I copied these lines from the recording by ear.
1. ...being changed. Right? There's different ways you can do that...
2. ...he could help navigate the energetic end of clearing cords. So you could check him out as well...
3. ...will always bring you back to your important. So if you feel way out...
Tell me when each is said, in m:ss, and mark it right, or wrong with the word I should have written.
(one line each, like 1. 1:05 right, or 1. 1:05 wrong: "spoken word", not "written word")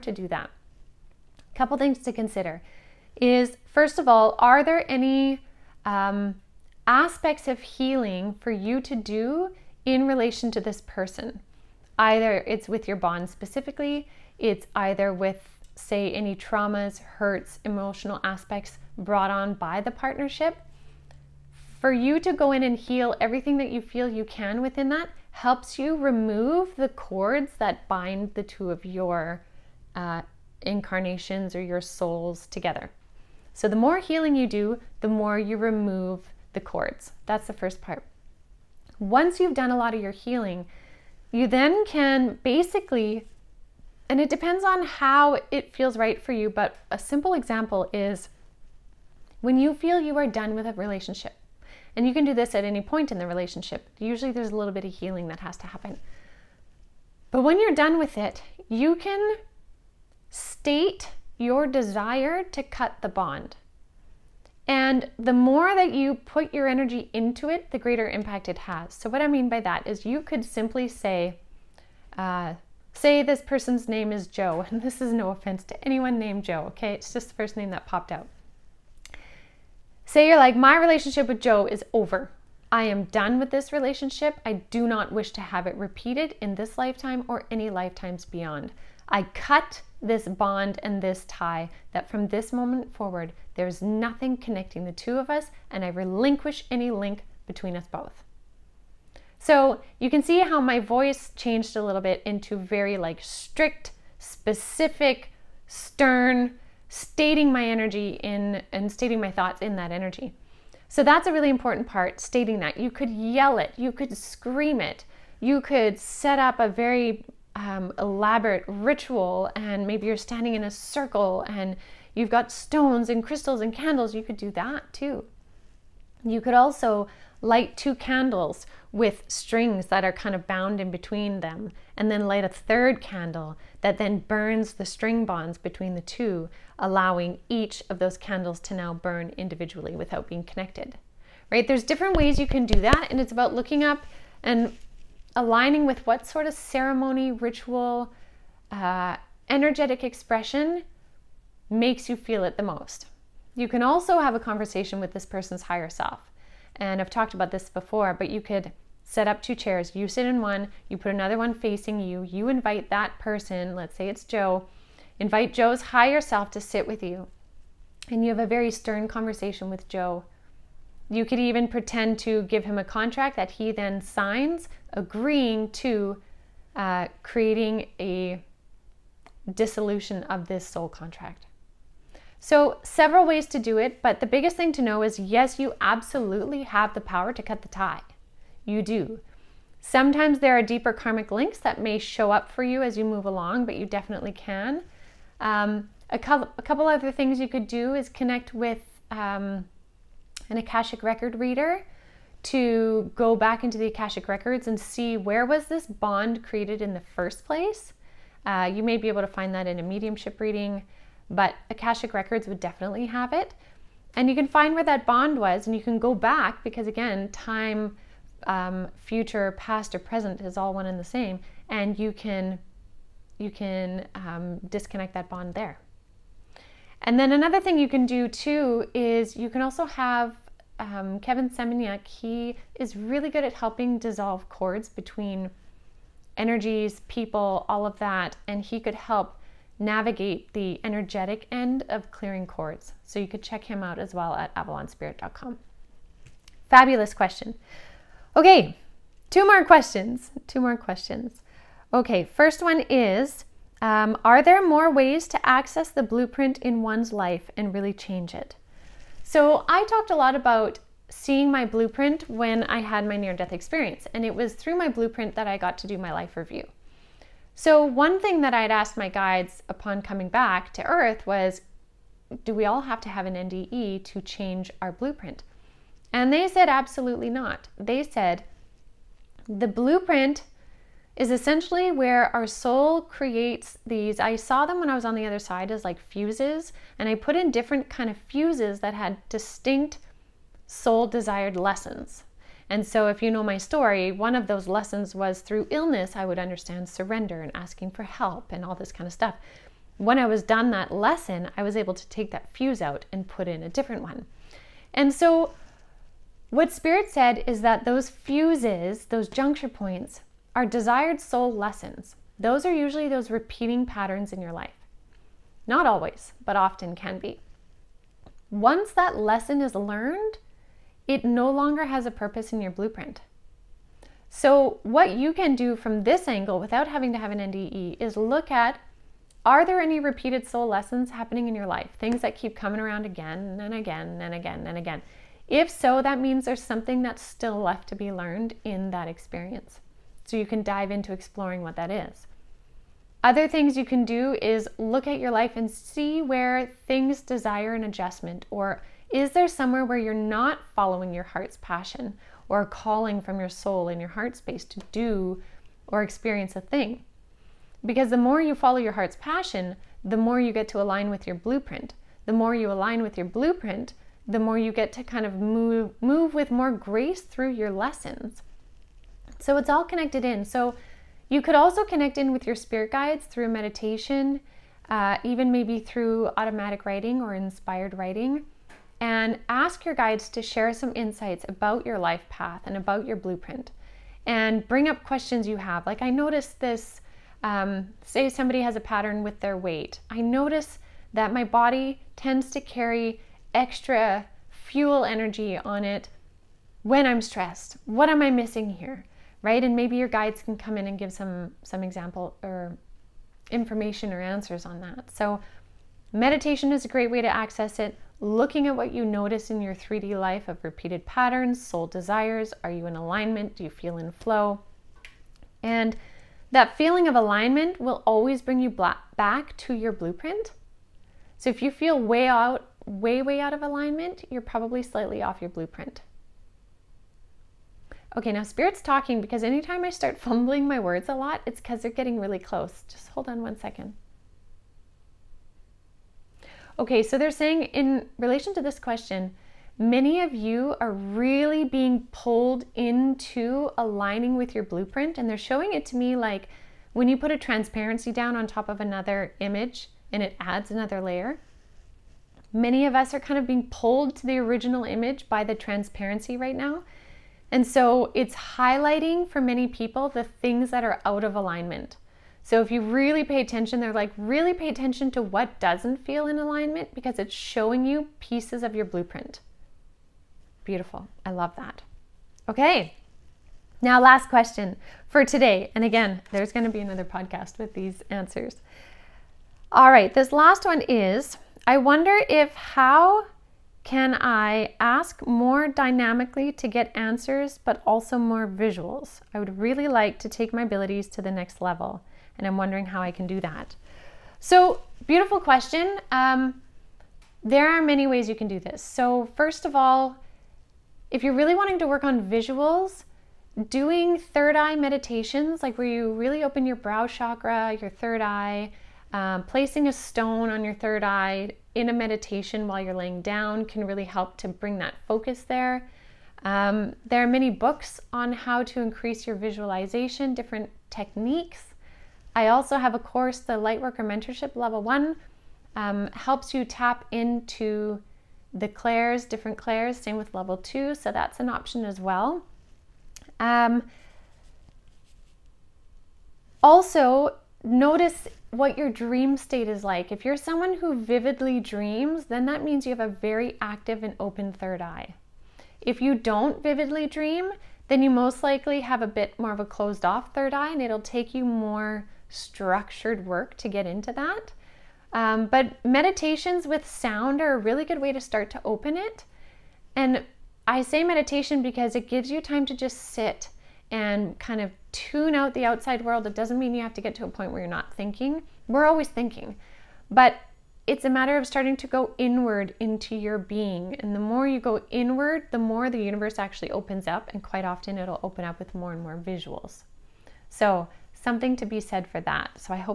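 1. 2:20 wrong: "connected", not "changed"
2. 3:58 right
3. 6:57 wrong: "blueprint", not "important".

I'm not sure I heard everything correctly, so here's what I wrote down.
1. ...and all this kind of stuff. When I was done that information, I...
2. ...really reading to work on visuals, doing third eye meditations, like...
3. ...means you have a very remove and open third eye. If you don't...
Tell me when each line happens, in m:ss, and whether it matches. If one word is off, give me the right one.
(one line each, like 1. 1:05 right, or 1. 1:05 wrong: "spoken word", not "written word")
1. 4:58 wrong: "lesson", not "information"
2. 8:21 wrong: "wanting", not "reading"
3. 9:02 wrong: "active", not "remove".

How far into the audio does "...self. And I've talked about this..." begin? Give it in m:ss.
2:35.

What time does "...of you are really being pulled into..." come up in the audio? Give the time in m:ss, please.
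7:20.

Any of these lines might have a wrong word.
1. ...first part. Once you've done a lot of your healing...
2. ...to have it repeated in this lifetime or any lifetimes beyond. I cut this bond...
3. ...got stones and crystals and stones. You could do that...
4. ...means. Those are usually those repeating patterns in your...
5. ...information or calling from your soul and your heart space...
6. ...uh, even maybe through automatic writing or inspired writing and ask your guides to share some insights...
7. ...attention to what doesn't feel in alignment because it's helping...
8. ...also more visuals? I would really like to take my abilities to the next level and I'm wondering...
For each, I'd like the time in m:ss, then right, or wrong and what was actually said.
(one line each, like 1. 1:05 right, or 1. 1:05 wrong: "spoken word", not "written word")
1. 0:37 right
2. 1:25 right
3. 2:02 wrong: "candles", not "stones"
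4. 5:11 wrong: "lessons", not "means"
5. 5:51 wrong: "passion", not "information"
6. 6:14 right
7. 7:44 wrong: "showing", not "helping"
8. 8:07 right.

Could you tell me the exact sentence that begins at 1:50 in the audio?
So that's a really important part, stating that.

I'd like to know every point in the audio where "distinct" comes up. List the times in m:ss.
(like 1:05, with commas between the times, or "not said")
4:49.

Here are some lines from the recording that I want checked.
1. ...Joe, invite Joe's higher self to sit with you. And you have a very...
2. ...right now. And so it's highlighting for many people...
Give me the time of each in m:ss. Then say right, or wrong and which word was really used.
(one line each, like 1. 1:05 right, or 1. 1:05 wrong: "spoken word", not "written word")
1. 2:44 right
2. 7:36 right.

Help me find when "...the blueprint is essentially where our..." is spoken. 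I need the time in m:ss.
4:39.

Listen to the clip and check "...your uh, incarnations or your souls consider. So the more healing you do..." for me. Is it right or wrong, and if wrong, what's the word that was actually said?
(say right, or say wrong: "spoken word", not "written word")
wrong: "together", not "consider".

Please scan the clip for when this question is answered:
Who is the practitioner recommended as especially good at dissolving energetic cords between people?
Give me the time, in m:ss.
3:51.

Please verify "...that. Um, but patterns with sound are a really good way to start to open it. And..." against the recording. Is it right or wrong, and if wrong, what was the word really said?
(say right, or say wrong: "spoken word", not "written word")
wrong: "meditations", not "patterns".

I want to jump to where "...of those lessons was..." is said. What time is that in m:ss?
4:54.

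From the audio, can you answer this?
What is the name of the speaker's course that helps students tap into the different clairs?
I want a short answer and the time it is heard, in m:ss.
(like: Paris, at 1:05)
Lightworker Mentorship, at 8:43.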